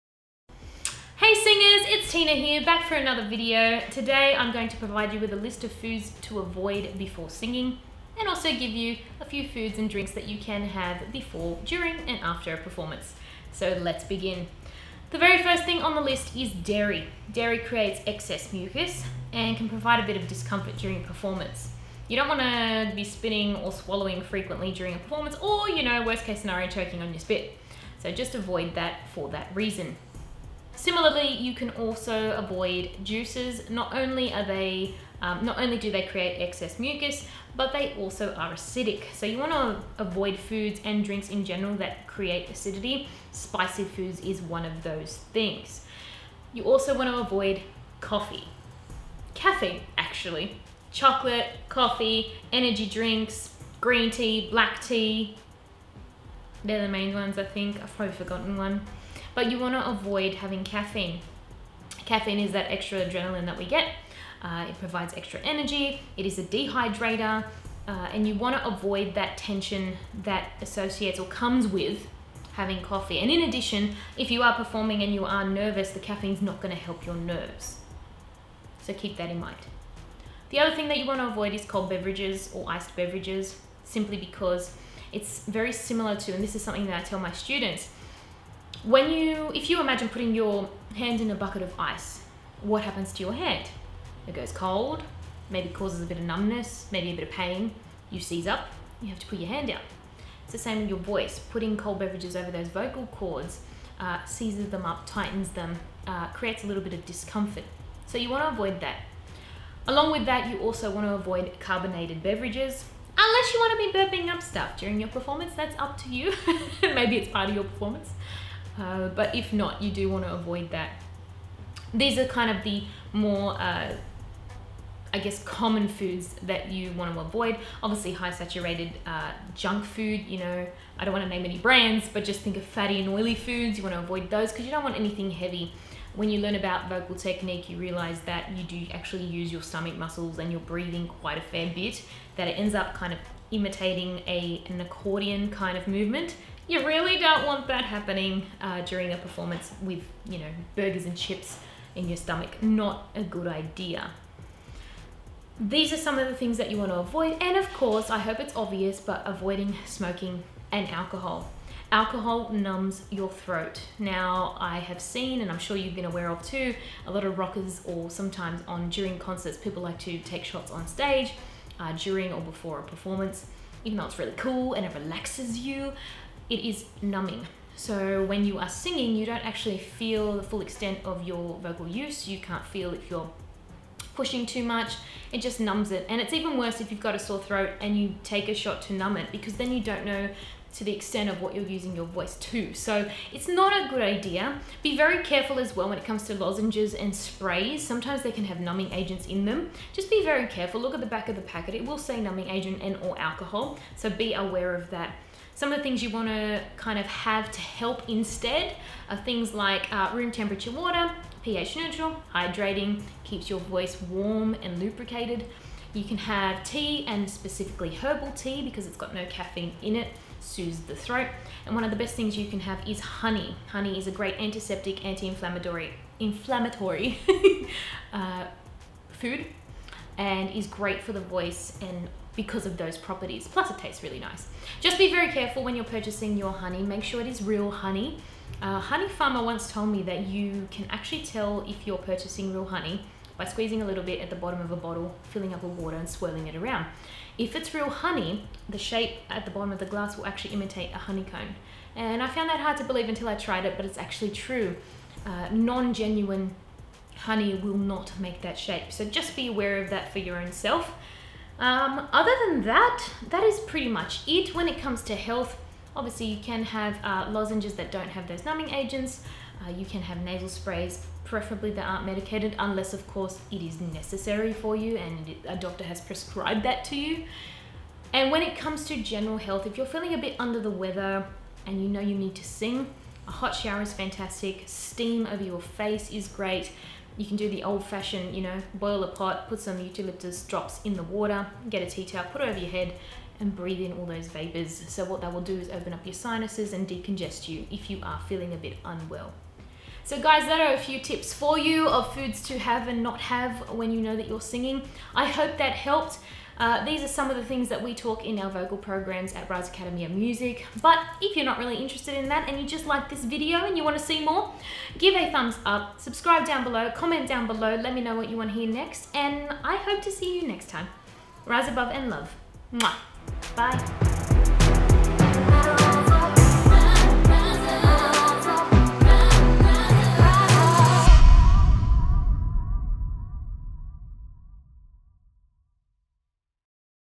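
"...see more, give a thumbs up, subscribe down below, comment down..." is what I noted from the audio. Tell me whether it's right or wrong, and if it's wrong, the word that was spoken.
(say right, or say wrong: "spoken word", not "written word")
right.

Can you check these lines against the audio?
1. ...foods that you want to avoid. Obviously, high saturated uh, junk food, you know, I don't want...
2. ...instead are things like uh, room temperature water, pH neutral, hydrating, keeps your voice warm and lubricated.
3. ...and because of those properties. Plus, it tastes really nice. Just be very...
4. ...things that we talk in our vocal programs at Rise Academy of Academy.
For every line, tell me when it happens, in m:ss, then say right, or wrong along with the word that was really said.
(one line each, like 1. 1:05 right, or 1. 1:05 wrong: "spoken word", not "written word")
1. 2:05 right
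2. 3:28 right
3. 3:51 right
4. 5:07 wrong: "Music", not "Academy".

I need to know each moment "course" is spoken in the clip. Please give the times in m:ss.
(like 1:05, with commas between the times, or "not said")
2:37, 4:33.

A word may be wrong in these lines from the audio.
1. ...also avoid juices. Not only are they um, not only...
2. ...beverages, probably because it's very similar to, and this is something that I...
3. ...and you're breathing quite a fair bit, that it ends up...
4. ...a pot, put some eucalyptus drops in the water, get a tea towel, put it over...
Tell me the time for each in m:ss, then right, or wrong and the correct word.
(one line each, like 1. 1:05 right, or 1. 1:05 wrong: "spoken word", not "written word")
1. 0:31 right
2. 1:22 wrong: "simply", not "probably"
3. 2:20 right
4. 4:49 right.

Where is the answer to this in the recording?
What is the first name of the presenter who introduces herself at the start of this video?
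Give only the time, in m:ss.
0:02.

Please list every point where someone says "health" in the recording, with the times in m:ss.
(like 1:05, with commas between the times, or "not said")
4:25, 4:39.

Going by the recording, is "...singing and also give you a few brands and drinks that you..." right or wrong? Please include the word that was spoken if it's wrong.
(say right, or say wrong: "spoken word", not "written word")
wrong: "foods", not "brands".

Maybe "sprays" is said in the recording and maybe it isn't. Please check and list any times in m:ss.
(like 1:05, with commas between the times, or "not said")
3:17, 4:30.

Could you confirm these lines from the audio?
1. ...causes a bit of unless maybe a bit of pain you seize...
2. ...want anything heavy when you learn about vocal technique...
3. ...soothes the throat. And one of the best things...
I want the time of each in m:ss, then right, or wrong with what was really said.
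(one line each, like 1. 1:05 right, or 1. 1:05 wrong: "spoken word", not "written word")
1. 1:35 wrong: "numbness", not "unless"
2. 2:14 right
3. 3:40 right.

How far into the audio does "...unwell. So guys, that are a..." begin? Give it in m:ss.
4:58.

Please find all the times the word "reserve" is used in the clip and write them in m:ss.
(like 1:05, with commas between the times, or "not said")
not said.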